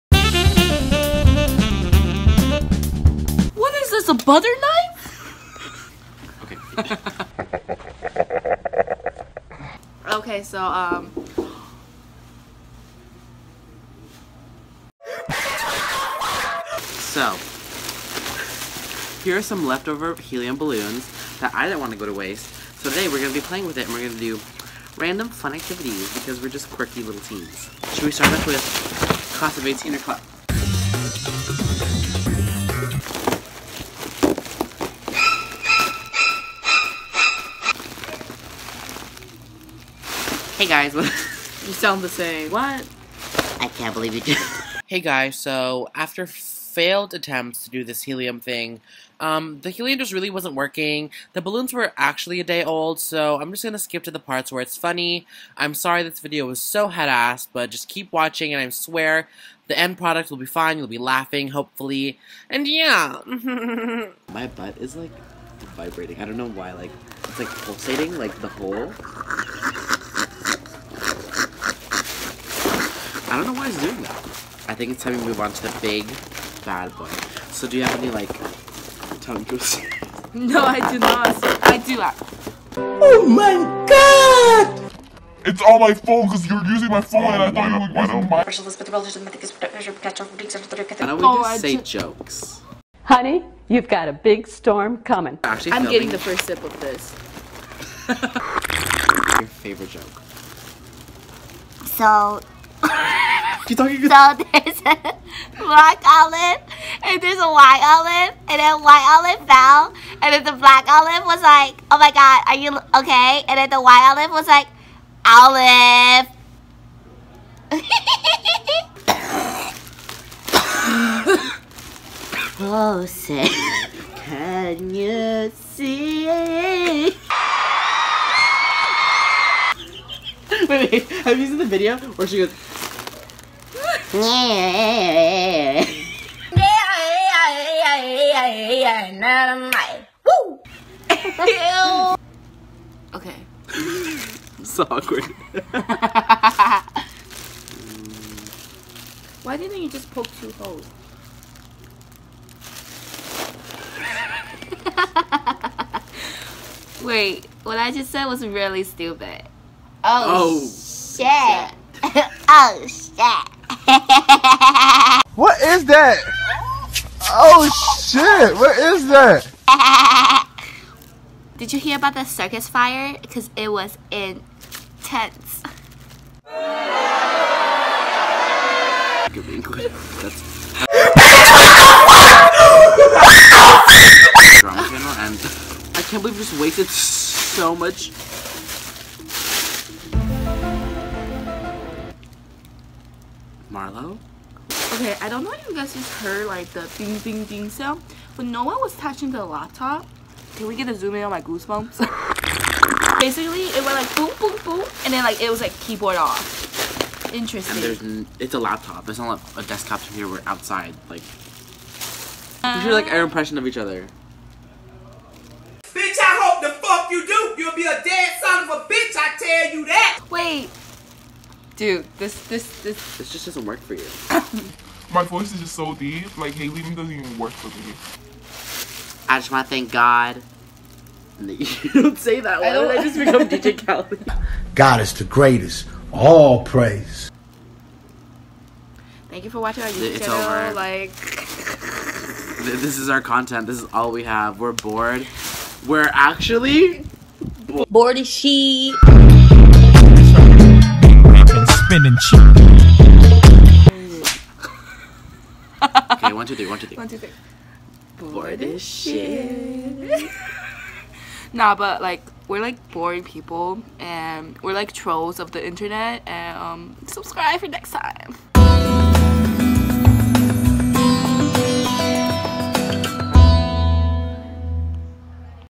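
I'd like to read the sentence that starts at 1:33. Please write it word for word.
Honey, you've got a big storm coming.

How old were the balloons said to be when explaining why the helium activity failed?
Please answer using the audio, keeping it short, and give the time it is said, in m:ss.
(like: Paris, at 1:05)
a day old, at 0:52.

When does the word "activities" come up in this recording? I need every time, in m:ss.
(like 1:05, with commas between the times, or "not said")
0:25.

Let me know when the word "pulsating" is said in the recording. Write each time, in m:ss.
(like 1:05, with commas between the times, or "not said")
1:07.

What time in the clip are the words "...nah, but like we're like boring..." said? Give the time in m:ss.
4:21.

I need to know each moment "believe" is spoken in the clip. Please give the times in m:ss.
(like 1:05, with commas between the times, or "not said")
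0:43, 3:06.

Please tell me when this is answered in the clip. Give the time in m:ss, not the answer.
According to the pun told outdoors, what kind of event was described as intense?
2:52.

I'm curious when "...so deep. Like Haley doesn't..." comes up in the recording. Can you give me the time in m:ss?
3:45.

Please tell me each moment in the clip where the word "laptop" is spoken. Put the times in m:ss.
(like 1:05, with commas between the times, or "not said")
3:19, 3:28.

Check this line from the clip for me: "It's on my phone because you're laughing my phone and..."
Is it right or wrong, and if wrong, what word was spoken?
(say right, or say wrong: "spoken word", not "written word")
wrong: "using", not "laughing".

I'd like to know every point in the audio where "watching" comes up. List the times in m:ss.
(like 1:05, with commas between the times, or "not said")
0:58, 3:59.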